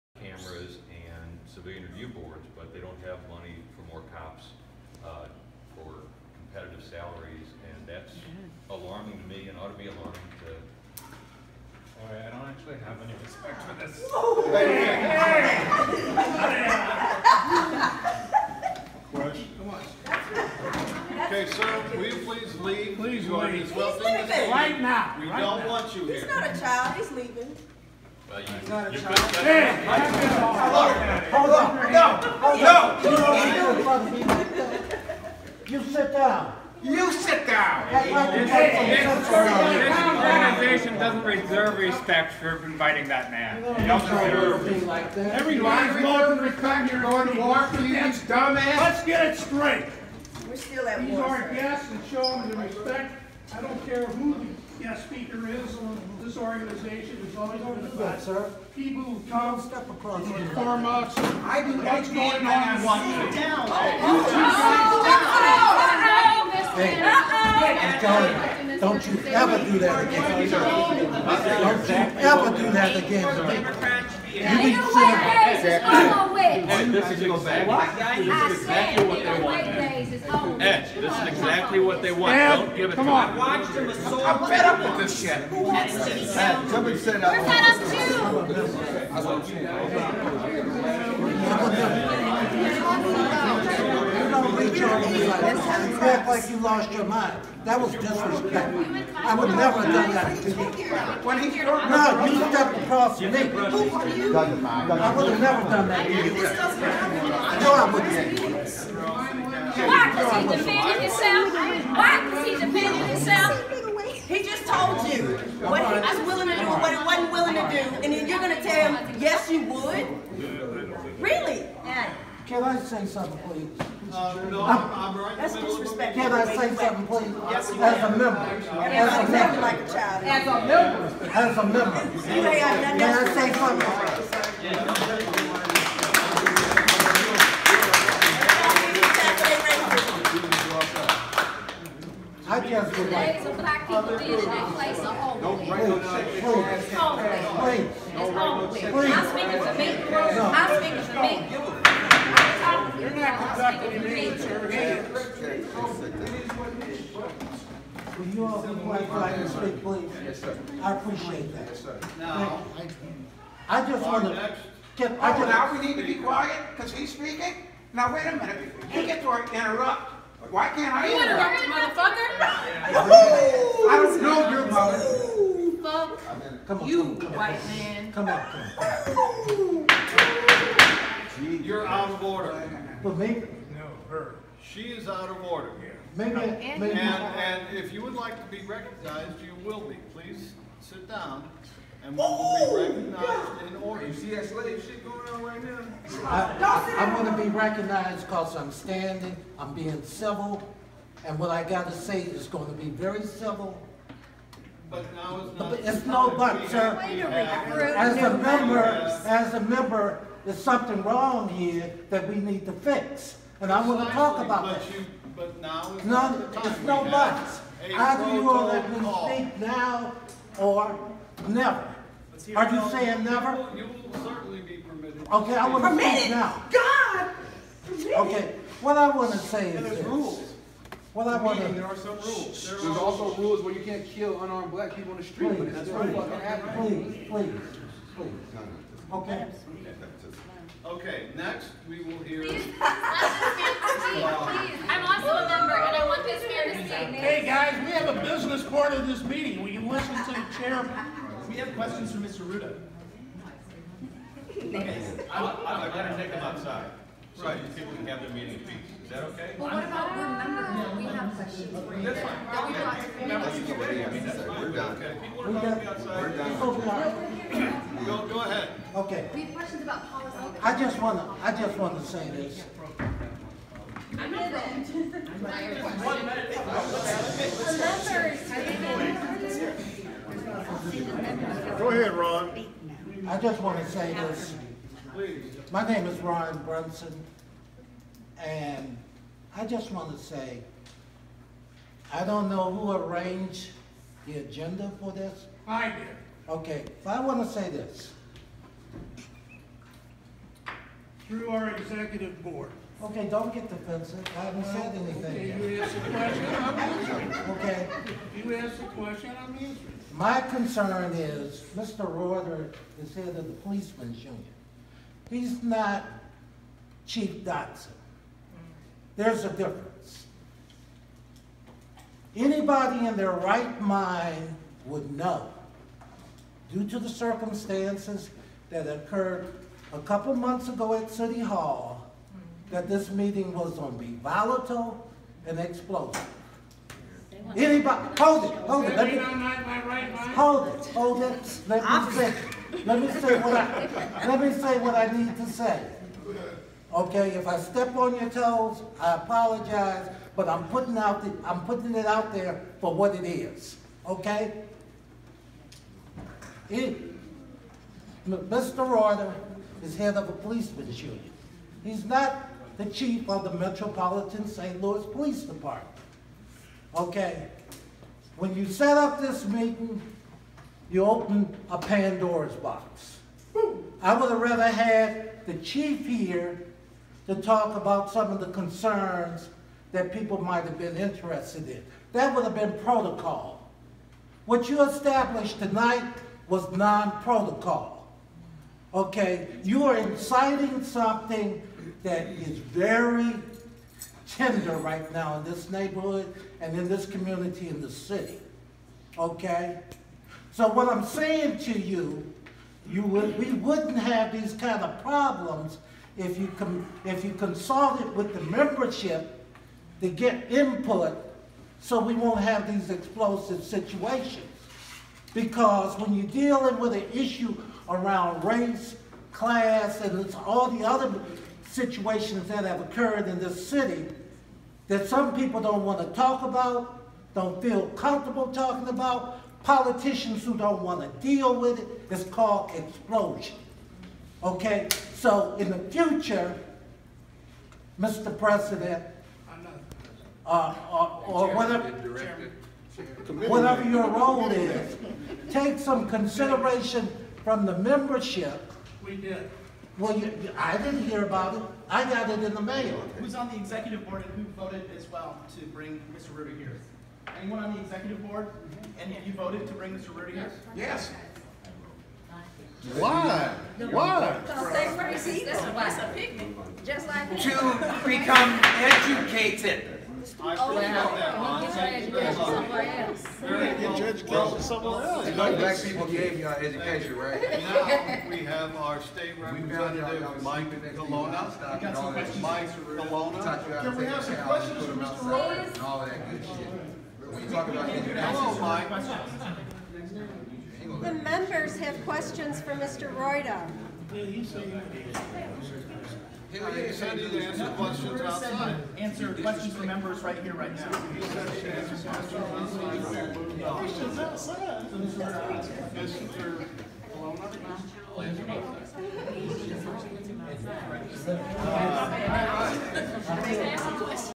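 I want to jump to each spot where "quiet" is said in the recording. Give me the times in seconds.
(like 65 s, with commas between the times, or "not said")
158 s, 166 s.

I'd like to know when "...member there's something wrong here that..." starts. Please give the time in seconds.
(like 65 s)
209 s.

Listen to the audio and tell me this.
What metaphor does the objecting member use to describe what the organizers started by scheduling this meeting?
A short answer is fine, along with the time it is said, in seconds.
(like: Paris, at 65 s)
Pandora's box, at 371 s.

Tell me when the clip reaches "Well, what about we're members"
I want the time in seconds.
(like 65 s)
259 s.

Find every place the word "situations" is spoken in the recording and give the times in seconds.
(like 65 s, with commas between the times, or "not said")
413 s, 421 s.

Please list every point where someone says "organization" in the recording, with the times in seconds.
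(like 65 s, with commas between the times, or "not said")
40 s, 56 s.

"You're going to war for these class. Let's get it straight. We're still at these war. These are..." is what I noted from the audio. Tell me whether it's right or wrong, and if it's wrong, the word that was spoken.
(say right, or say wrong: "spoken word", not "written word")
wrong: "dumbass", not "class".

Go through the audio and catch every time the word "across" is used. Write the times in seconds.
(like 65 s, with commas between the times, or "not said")
59 s, 102 s.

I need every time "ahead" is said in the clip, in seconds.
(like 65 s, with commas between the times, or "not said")
268 s, 281 s.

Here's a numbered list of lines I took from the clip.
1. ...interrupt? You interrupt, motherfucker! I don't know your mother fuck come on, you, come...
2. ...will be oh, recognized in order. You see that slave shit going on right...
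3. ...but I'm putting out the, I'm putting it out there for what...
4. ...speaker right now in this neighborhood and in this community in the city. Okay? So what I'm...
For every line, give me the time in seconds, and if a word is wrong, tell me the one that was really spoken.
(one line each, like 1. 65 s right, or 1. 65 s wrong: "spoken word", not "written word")
1. 171 s right
2. 192 s right
3. 350 s right
4. 394 s wrong: "tender", not "speaker".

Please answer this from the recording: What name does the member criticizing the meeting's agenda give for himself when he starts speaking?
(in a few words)
Ron Brunson.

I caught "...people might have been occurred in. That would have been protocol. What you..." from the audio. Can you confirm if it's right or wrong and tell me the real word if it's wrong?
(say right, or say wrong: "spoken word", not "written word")
wrong: "interested", not "occurred".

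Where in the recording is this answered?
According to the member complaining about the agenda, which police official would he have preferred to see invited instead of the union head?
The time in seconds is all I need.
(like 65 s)
317 s.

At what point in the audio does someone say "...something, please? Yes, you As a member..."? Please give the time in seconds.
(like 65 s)
126 s.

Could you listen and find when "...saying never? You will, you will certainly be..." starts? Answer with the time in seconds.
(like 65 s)
222 s.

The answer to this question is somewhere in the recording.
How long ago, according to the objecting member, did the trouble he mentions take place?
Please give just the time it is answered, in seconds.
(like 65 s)
329 s.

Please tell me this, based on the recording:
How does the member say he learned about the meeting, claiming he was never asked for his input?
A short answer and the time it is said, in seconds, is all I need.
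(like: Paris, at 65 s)
In the mail, at 452 s.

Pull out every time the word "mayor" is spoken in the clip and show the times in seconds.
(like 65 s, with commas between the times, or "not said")
246 s.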